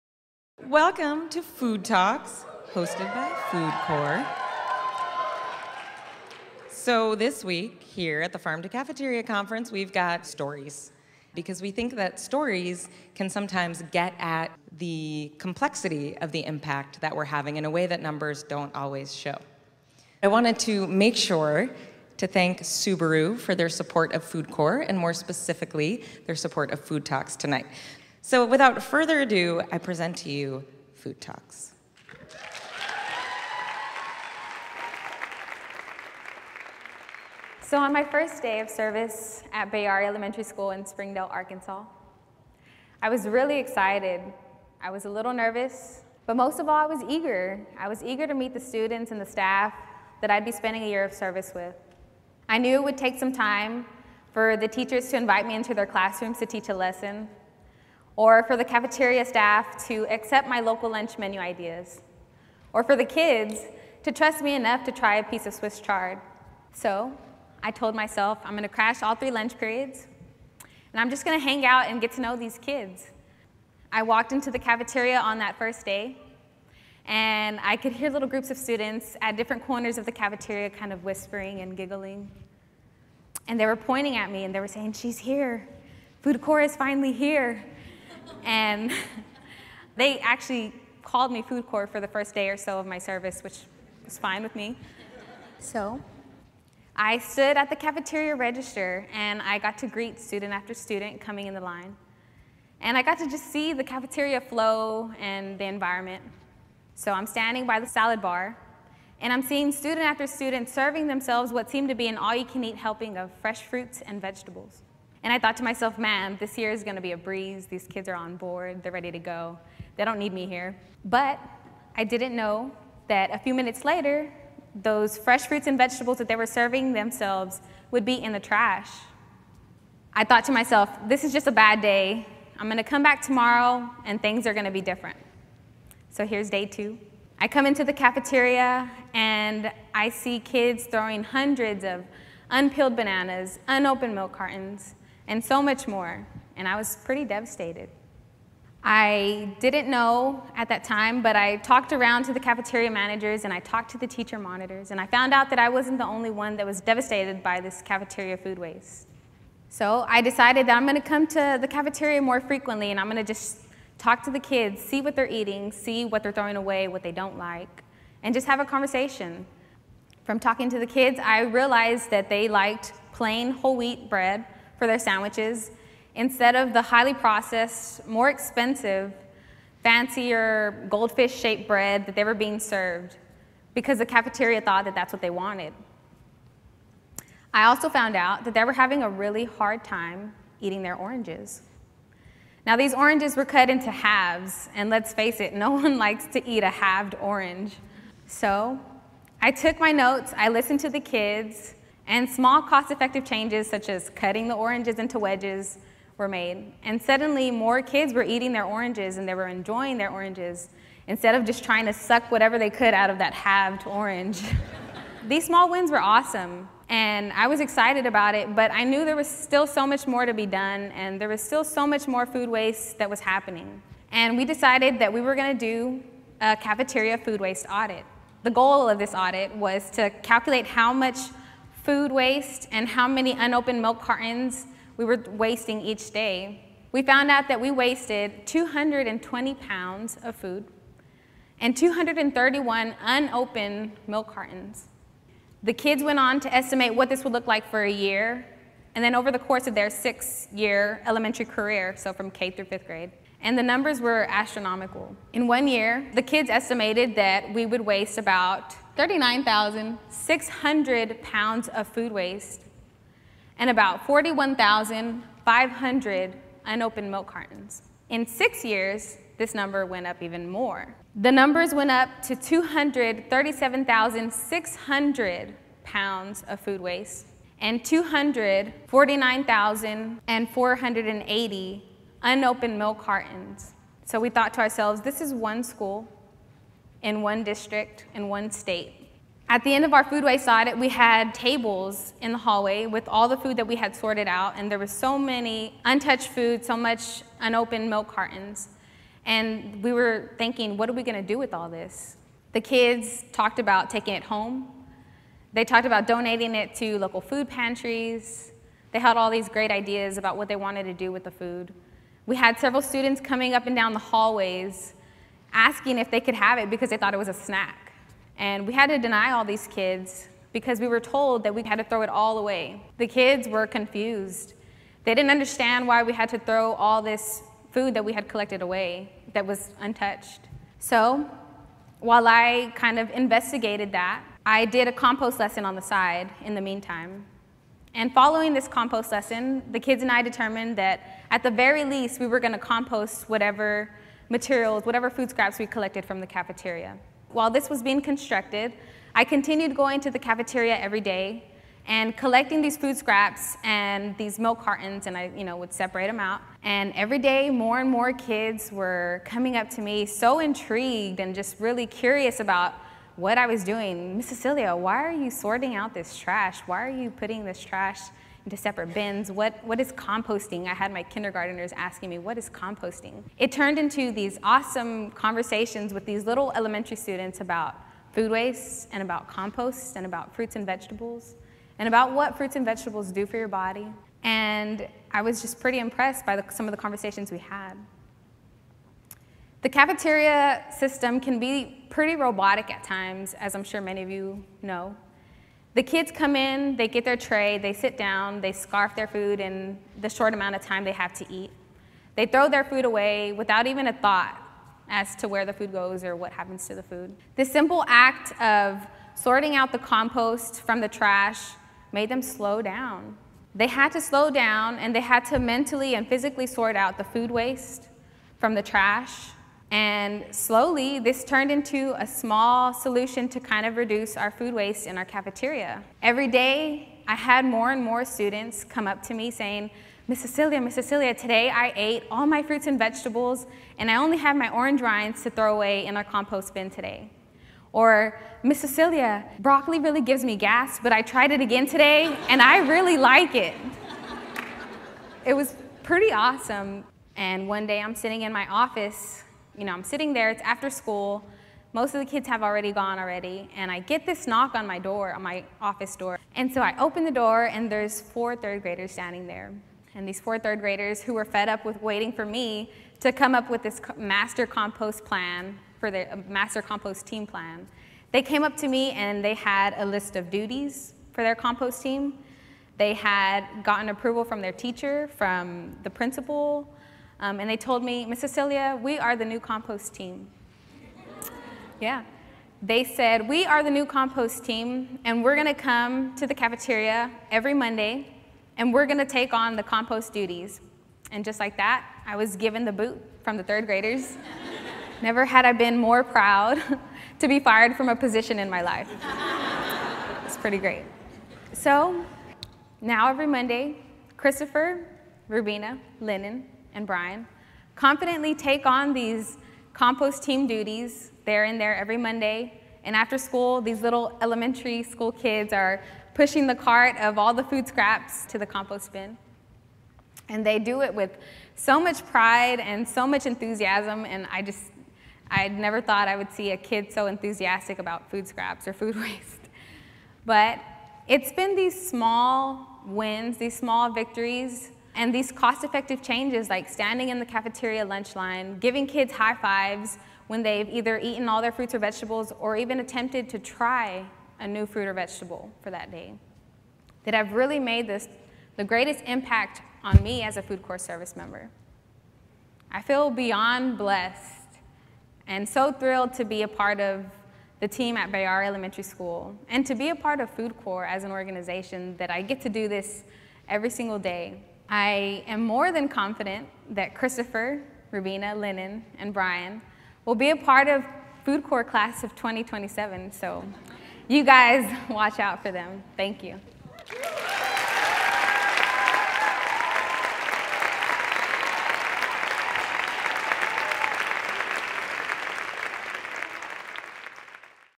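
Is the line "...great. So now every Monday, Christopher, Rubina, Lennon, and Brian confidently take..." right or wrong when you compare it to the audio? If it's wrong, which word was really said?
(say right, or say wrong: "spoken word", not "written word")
right.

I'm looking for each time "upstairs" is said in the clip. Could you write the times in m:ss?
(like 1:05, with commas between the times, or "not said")
not said.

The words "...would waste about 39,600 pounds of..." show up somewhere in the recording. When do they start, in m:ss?
4:17.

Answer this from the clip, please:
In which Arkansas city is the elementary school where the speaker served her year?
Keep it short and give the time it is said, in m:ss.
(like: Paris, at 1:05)
Springdale, at 0:40.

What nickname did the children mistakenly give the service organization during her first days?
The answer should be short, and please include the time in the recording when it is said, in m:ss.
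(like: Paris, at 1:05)
Food court, at 1:31.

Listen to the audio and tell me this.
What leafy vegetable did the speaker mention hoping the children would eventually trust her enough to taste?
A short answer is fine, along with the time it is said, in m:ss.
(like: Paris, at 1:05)
Swiss chard, at 1:05.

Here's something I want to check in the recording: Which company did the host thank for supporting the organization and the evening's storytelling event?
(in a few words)
Subaru.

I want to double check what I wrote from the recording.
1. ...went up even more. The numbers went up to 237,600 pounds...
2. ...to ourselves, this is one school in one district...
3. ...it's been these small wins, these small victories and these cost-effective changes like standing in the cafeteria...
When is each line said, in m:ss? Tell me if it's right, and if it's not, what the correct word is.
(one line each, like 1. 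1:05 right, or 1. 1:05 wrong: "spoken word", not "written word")
1. 4:29 right
2. 4:44 right
3. 8:51 right.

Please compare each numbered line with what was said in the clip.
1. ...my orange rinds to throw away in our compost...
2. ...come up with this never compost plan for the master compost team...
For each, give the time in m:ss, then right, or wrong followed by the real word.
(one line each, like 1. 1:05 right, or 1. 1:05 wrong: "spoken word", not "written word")
1. 7:14 right
2. 7:43 wrong: "master", not "never".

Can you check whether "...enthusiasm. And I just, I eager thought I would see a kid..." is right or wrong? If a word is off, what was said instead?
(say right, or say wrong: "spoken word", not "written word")
wrong: "never", not "eager".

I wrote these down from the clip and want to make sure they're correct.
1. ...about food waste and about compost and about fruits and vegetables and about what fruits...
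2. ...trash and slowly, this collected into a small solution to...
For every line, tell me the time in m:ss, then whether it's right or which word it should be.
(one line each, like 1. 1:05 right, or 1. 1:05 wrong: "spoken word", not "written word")
1. 6:17 right
2. 6:58 wrong: "turned", not "collected".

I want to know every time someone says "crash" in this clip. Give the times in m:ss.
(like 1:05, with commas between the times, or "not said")
1:08.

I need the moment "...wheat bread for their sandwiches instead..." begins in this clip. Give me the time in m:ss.
2:53.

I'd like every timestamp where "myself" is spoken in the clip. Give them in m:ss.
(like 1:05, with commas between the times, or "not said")
1:07, 1:55, 2:10.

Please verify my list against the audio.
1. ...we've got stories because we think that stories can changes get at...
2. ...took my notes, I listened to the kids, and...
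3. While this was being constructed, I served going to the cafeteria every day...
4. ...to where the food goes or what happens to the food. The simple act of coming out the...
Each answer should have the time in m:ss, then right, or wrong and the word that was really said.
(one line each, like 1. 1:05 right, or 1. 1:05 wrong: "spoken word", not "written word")
1. 0:09 wrong: "sometimes", not "changes"
2. 3:19 right
3. 5:47 wrong: "continued", not "served"
4. 6:45 wrong: "sorting", not "coming".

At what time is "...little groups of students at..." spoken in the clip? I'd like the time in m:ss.
1:18.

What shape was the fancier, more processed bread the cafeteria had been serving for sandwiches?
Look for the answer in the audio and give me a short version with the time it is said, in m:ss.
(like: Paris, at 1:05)
goldfish, at 3:00.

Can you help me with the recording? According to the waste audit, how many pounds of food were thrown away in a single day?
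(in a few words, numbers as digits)
220.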